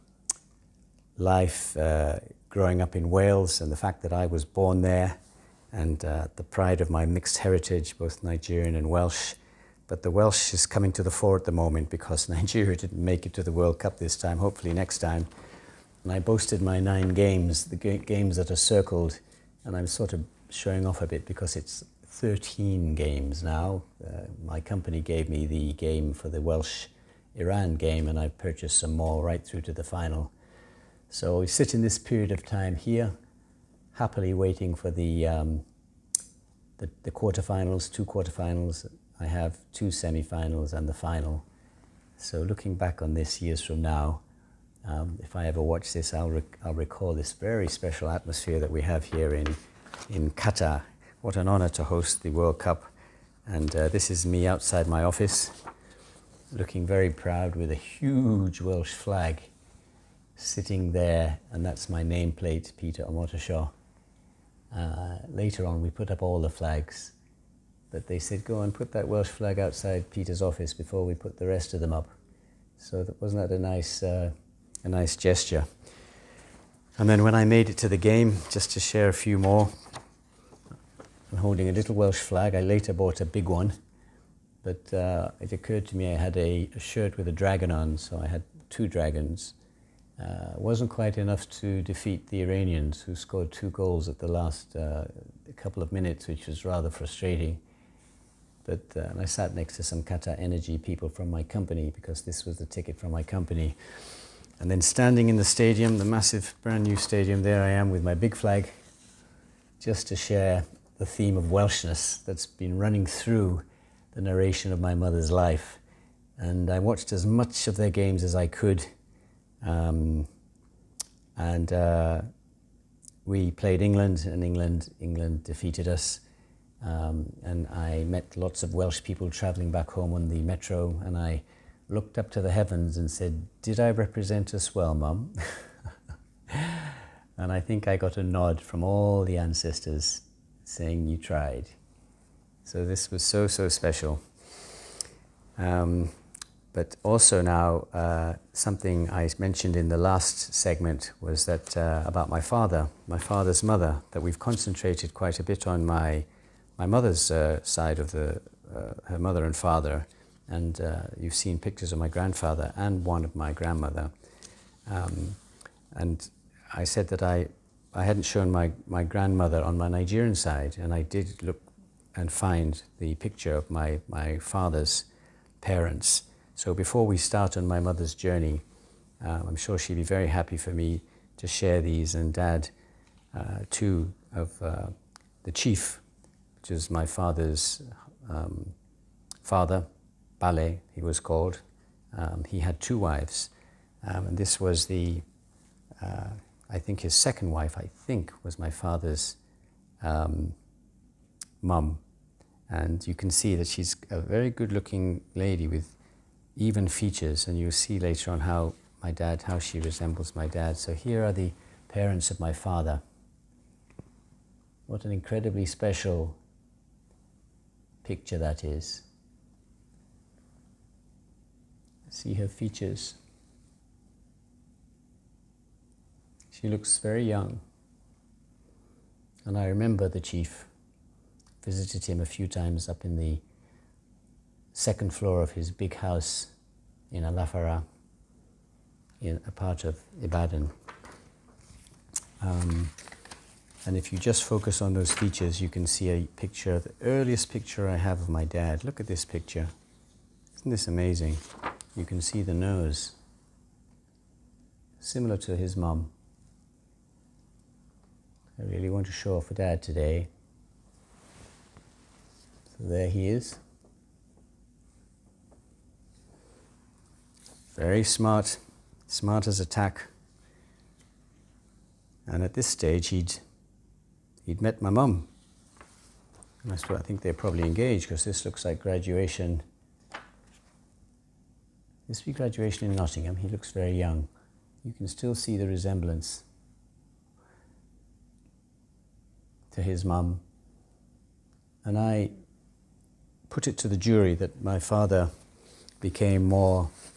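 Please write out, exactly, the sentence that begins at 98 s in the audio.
But uh, I sat next to some Qatar Energy people from my company because this was the ticket from my company.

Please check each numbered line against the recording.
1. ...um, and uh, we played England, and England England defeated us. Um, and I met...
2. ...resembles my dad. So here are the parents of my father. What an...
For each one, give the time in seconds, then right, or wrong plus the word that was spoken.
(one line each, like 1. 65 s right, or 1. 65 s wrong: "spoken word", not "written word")
1. 119 s right
2. 209 s right.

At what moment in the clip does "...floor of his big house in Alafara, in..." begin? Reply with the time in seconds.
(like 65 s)
235 s.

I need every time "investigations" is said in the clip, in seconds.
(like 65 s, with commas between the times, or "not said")
not said.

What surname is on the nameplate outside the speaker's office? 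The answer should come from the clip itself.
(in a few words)
Omotoso.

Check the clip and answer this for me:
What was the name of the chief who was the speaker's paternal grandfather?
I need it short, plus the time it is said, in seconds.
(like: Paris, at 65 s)
Bale, at 190 s.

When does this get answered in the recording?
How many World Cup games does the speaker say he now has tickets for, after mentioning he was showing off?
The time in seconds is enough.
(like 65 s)
22 s.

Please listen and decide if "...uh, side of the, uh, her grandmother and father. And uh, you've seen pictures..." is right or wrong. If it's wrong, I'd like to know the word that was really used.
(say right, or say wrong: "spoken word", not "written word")
wrong: "mother", not "grandmother".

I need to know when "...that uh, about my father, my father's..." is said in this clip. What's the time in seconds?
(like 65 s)
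151 s.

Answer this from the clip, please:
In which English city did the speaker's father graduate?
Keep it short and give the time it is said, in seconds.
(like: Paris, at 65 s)
Nottingham, at 282 s.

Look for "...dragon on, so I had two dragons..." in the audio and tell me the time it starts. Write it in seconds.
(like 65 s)
87 s.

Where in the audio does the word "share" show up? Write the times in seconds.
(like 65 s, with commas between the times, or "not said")
78 s, 110 s, 181 s.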